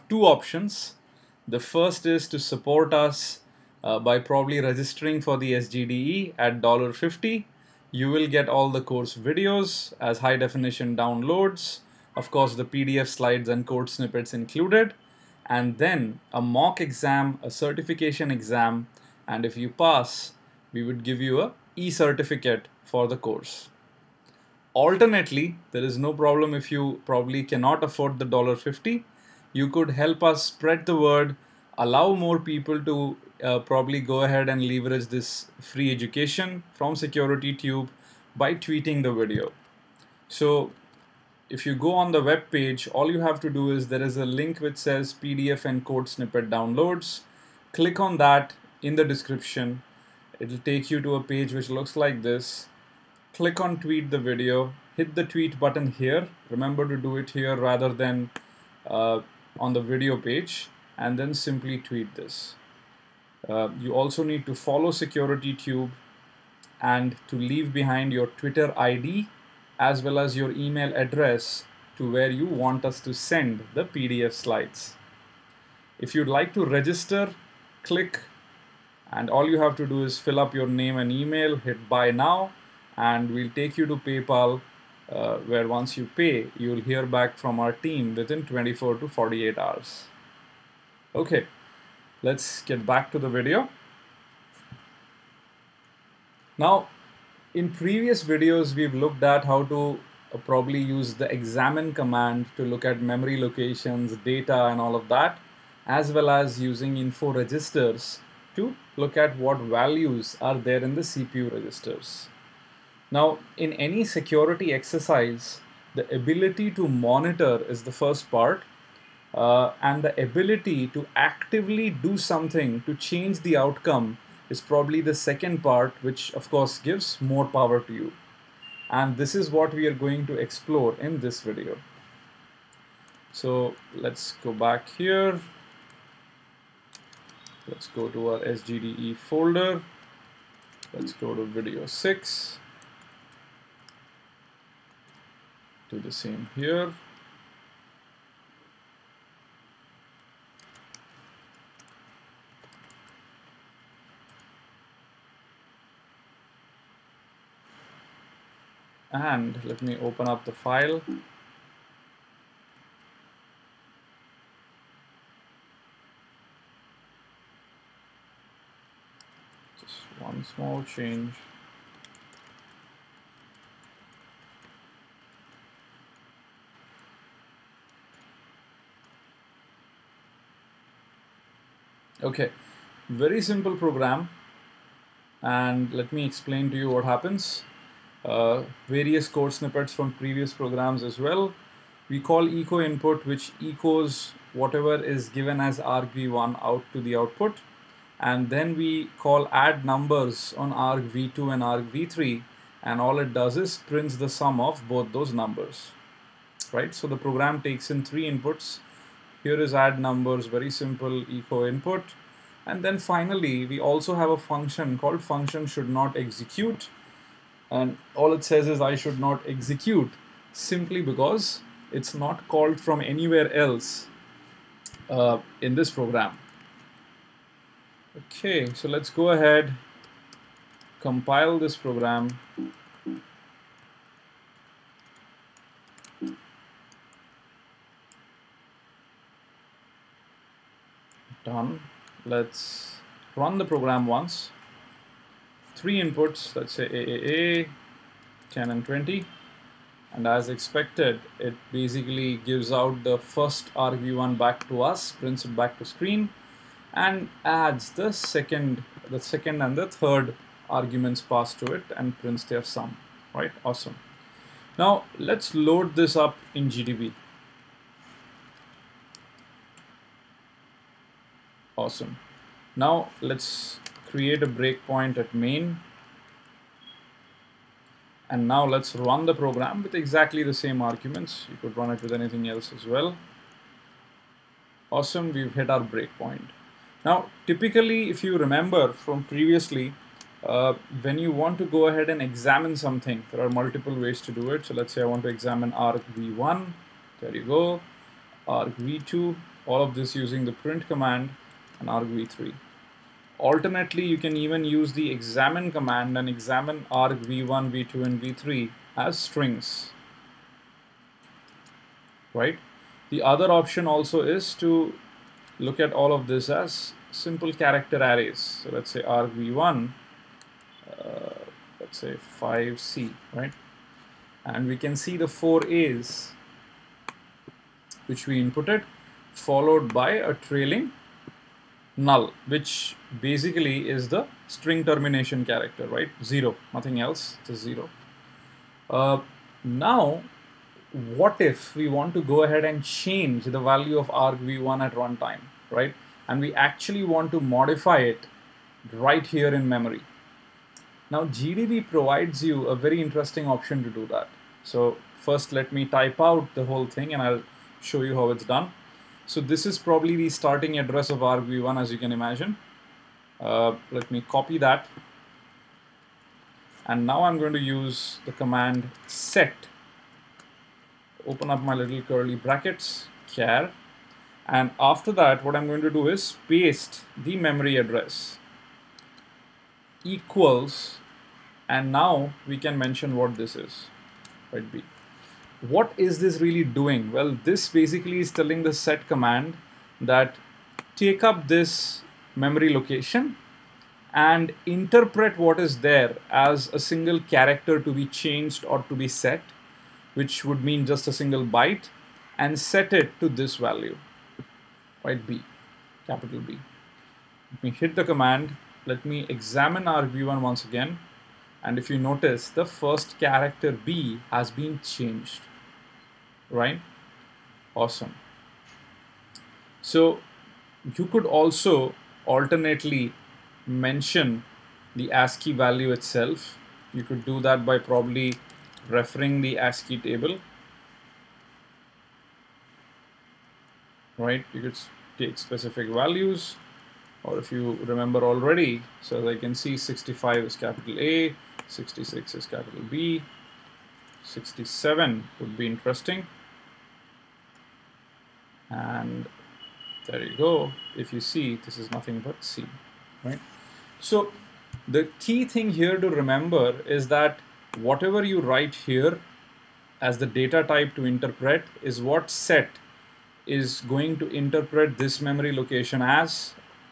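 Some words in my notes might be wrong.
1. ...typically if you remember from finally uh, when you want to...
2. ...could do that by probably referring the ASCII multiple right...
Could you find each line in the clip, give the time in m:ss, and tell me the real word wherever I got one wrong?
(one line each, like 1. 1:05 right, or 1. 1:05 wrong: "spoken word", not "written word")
1. 4:47 wrong: "previously", not "finally"
2. 7:07 wrong: "table", not "multiple".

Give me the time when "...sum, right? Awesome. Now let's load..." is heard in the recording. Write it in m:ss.
4:22.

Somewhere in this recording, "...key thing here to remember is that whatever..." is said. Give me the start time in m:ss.
7:35.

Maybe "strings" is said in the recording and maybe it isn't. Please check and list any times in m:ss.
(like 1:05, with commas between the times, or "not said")
5:09, 5:34.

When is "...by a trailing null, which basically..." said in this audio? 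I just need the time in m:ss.
5:29.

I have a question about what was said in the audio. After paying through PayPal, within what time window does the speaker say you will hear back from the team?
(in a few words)
24 to 48 hours.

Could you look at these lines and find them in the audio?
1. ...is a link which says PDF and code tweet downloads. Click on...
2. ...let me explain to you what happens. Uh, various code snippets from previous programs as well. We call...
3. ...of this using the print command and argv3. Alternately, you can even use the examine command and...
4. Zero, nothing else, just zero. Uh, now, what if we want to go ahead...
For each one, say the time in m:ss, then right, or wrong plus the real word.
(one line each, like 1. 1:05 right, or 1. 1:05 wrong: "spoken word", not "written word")
1. 0:44 wrong: "snippet", not "tweet"
2. 3:05 right
3. 4:59 right
4. 5:36 right.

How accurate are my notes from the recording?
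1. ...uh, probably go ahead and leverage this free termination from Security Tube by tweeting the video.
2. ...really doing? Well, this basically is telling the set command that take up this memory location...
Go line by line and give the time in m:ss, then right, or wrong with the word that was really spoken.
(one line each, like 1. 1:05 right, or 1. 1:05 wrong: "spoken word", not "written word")
1. 0:33 wrong: "education", not "termination"
2. 6:26 right.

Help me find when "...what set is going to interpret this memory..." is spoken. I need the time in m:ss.
7:42.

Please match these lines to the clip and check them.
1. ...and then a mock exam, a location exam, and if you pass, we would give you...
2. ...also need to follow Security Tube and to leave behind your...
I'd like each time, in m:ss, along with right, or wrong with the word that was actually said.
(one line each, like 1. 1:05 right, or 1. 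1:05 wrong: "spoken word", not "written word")
1. 0:15 wrong: "certification", not "location"
2. 1:03 right.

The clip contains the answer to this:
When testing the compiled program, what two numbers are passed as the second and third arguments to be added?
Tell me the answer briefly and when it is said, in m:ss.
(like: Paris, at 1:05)
10 and 20, at 4:08.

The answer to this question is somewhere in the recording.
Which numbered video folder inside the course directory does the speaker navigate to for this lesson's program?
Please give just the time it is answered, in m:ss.
2:21.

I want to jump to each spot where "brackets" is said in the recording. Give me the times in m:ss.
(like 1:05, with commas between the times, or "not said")
6:12.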